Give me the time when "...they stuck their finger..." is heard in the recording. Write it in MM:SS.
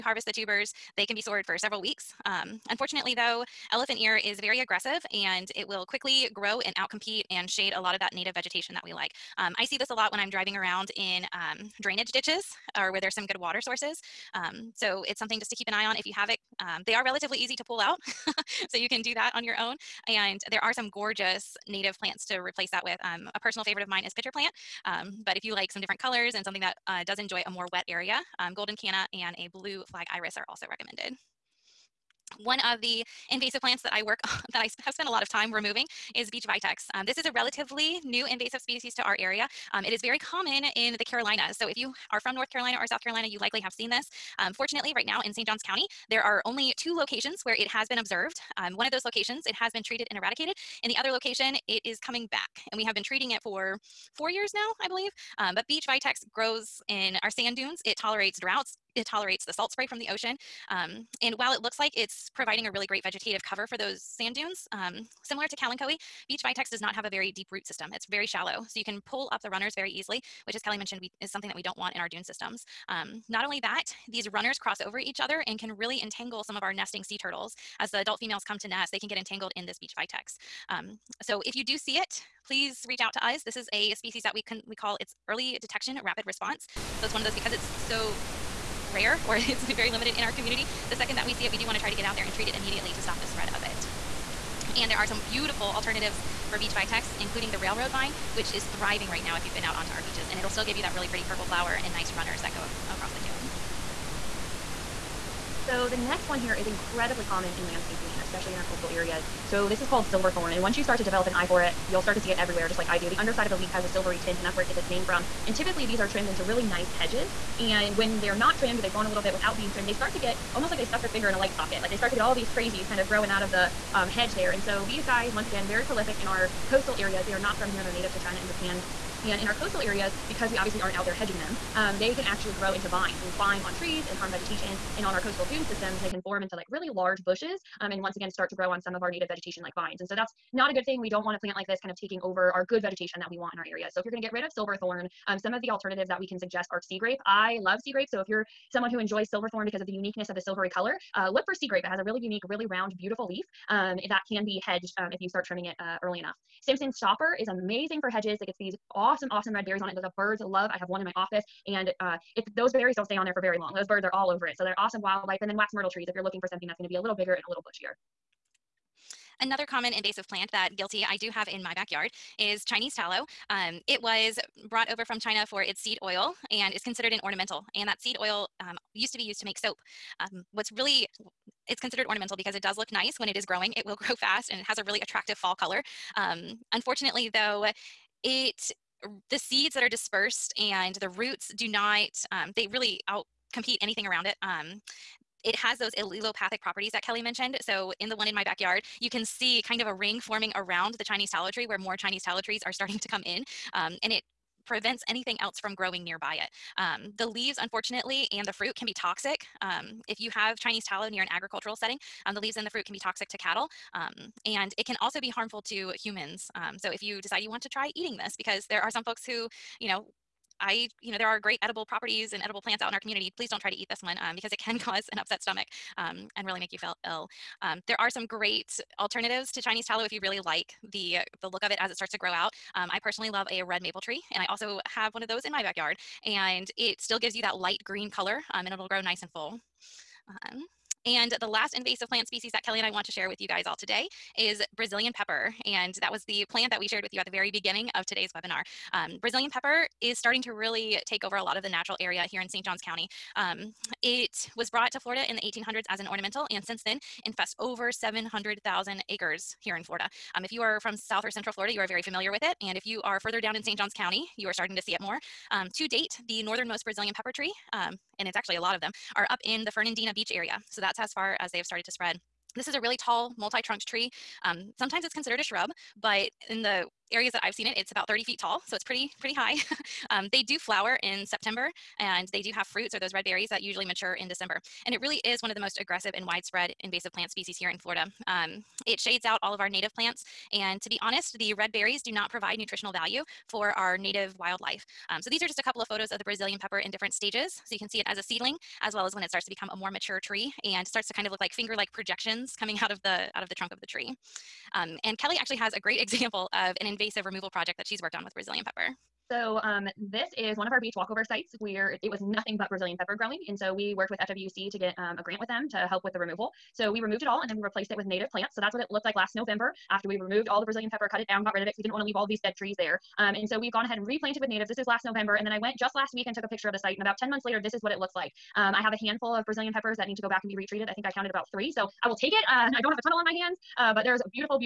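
02:00.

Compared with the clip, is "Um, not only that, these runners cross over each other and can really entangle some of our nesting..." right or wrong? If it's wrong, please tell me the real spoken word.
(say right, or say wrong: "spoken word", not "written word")
right.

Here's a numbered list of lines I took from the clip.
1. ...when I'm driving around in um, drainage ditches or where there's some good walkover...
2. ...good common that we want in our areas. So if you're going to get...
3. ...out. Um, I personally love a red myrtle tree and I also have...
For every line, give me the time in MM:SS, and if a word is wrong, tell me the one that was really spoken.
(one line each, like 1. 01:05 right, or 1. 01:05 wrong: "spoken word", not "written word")
1. 00:10 wrong: "water", not "walkover"
2. 02:22 wrong: "vegetation", not "common"
3. 03:52 wrong: "maple", not "myrtle".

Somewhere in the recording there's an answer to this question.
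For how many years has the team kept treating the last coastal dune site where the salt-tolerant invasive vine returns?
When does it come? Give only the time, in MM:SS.
00:54.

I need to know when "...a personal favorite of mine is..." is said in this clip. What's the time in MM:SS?
00:23.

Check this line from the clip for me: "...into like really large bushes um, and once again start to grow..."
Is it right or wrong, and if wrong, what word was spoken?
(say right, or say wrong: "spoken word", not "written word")
right.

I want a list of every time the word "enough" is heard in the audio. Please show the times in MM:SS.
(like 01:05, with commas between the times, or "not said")
02:36.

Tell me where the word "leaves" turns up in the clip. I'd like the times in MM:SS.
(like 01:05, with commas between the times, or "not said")
03:27, 03:32, 05:22.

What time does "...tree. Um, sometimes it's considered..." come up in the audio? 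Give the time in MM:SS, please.
04:33.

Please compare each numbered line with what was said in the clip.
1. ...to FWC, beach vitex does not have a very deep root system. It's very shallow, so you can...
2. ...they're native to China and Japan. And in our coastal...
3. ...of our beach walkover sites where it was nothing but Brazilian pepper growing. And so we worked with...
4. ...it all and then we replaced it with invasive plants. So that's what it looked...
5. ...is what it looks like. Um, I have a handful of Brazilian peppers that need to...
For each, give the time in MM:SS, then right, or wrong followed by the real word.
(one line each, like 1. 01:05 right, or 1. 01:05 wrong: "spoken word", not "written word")
1. 01:05 wrong: "Kalanchoe", not "FWC"
2. 02:07 right
3. 05:10 right
4. 05:17 wrong: "native", not "invasive"
5. 05:27 right.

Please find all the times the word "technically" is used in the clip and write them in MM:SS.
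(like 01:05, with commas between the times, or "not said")
not said.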